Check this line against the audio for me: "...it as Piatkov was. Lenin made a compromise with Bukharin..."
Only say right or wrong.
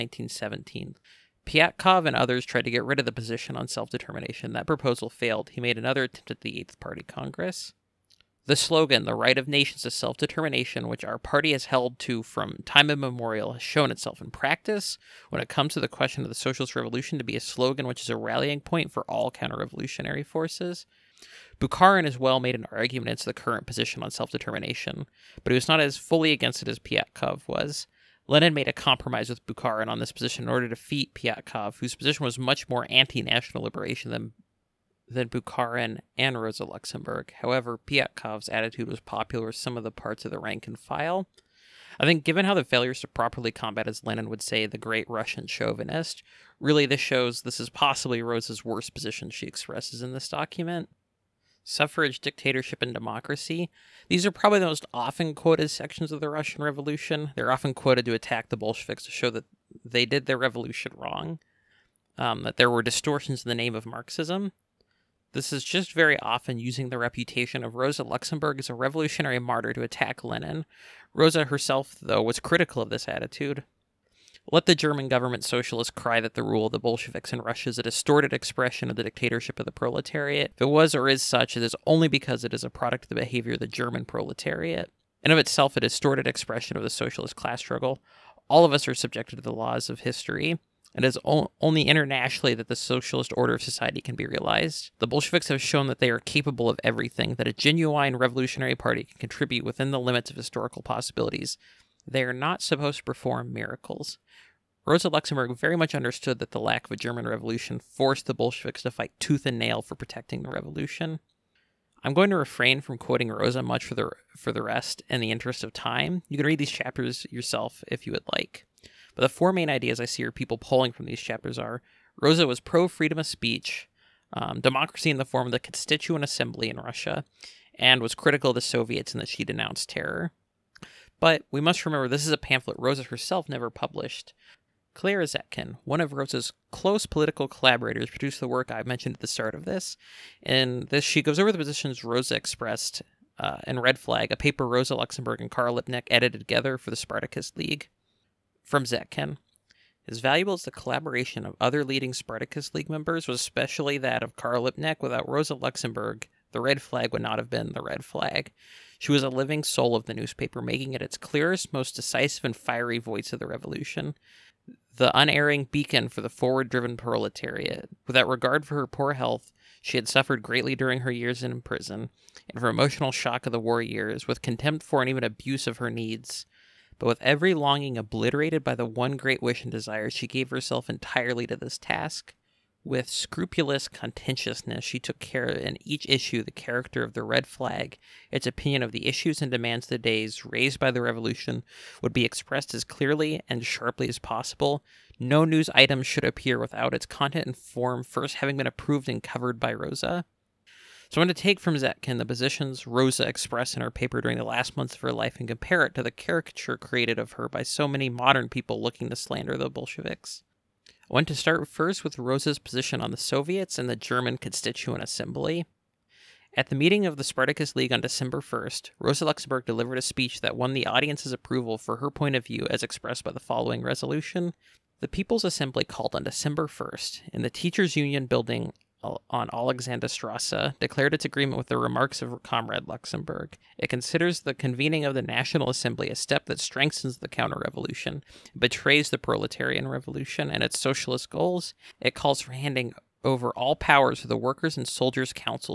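right.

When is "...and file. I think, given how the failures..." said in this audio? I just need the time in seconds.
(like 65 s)
40 s.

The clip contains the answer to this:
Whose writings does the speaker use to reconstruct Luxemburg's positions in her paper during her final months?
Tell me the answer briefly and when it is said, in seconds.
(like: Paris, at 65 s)
Clara Zetkin, at 134 s.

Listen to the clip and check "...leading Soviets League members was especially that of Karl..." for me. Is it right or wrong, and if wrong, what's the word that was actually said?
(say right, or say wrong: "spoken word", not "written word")
wrong: "Spartacus", not "Soviets".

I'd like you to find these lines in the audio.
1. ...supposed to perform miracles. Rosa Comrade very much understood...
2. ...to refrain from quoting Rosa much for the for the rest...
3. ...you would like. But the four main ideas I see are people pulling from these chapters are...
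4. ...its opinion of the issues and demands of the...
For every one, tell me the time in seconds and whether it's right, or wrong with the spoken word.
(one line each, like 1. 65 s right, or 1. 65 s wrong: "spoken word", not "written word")
1. 102 s wrong: "Luxemburg", not "Comrade"
2. 112 s right
3. 118 s right
4. 188 s right.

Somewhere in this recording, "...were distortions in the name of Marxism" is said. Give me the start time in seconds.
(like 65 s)
62 s.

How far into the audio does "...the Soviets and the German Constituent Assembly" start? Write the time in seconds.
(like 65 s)
213 s.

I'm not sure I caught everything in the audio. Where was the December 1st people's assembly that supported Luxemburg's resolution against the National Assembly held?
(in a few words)
Teachers Union building.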